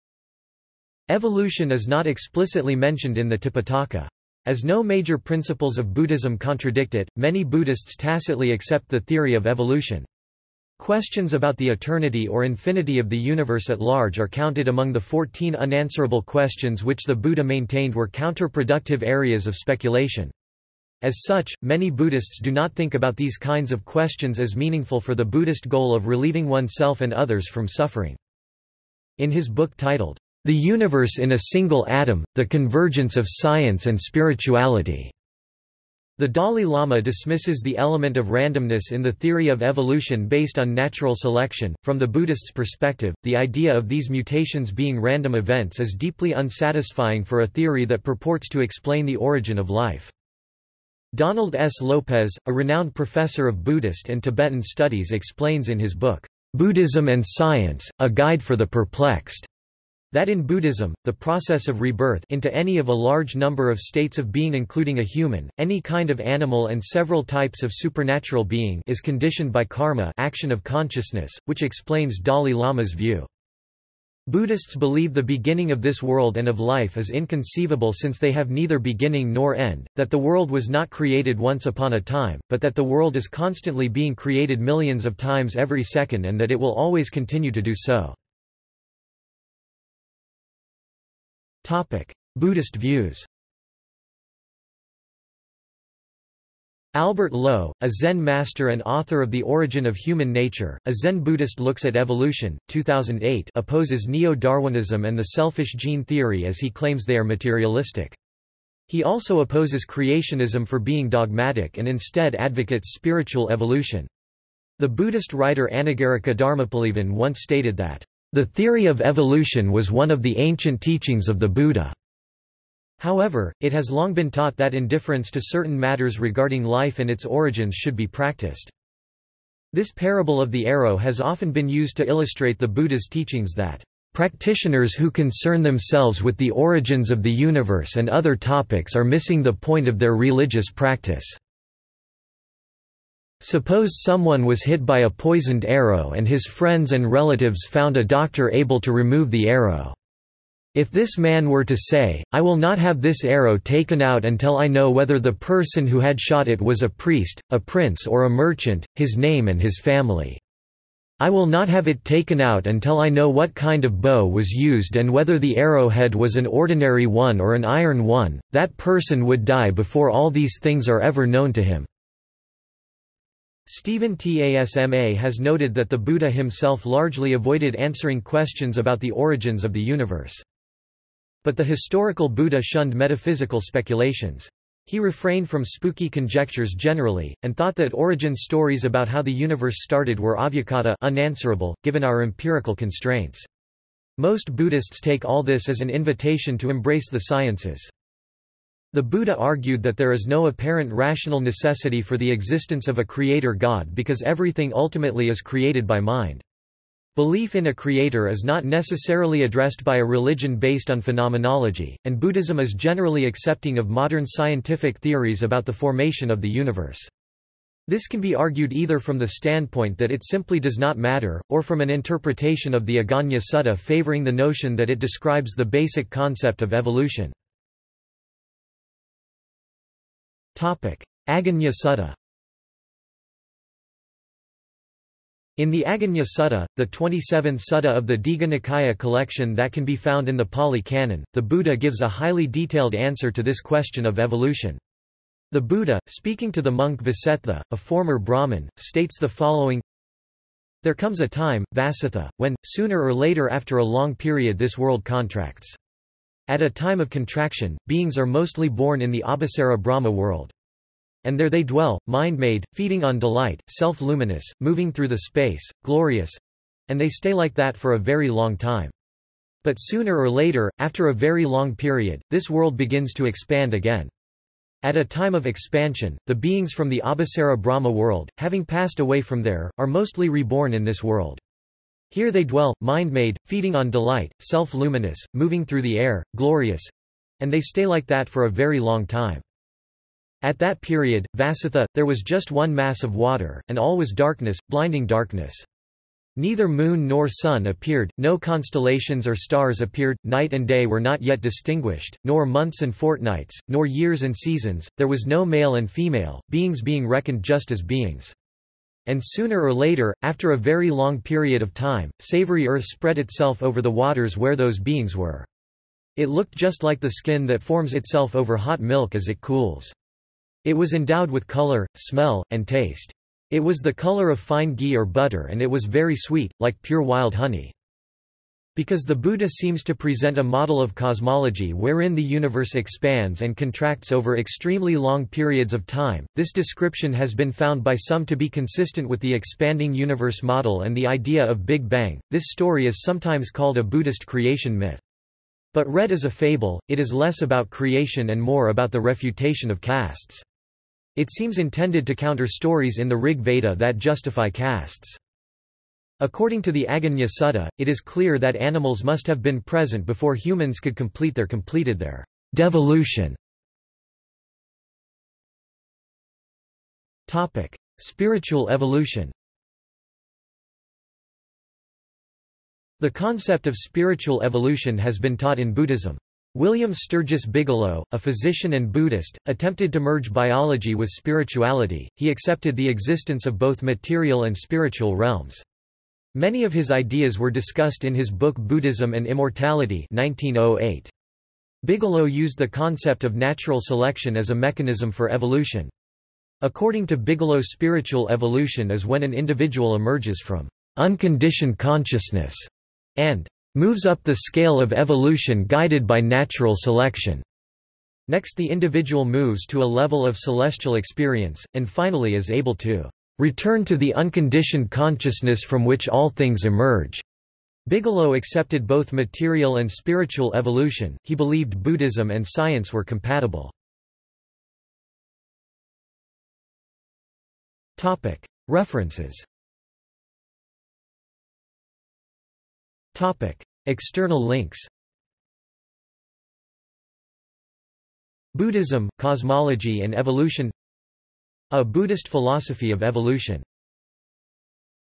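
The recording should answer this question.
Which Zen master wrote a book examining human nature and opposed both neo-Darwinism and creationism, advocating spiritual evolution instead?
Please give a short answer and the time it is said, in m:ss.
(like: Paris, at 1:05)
Albert Low, at 1:36.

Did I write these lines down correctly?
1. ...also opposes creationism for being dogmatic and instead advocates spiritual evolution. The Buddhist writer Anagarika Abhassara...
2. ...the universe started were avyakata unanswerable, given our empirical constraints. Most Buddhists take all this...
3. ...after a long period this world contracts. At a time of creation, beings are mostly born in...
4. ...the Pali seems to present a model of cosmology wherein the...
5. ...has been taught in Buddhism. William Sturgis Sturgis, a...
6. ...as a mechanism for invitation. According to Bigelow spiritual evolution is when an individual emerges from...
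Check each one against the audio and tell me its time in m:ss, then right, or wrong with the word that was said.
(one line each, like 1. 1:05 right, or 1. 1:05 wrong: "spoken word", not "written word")
1. 1:49 wrong: "Dharmapalavan", not "Abhassara"
2. 3:09 right
3. 4:13 wrong: "contraction", not "creation"
4. 5:29 wrong: "Buddha", not "Pali"
5. 6:14 wrong: "Bigelow", not "Sturgis"
6. 6:34 wrong: "evolution", not "invitation".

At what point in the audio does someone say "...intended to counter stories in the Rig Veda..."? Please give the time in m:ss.
5:51.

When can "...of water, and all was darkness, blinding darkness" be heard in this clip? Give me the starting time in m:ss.
4:53.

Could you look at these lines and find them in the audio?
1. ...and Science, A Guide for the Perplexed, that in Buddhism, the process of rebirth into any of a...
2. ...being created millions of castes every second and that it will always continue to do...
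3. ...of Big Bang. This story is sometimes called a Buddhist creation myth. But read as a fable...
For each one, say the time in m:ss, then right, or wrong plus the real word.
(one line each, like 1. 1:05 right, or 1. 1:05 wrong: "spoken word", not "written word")
1. 0:57 right
2. 1:23 wrong: "times", not "castes"
3. 5:41 right.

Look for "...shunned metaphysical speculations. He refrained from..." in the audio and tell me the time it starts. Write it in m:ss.
3:02.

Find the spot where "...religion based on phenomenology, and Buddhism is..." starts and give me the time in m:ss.
3:30.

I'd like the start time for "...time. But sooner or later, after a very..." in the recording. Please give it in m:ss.
4:28.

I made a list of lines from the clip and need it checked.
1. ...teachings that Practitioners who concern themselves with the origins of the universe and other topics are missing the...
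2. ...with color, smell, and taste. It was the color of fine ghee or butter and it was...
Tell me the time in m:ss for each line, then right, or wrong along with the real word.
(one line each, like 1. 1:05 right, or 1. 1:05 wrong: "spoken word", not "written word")
1. 2:13 right
2. 5:21 right.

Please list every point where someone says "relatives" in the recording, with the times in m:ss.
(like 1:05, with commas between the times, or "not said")
2:27.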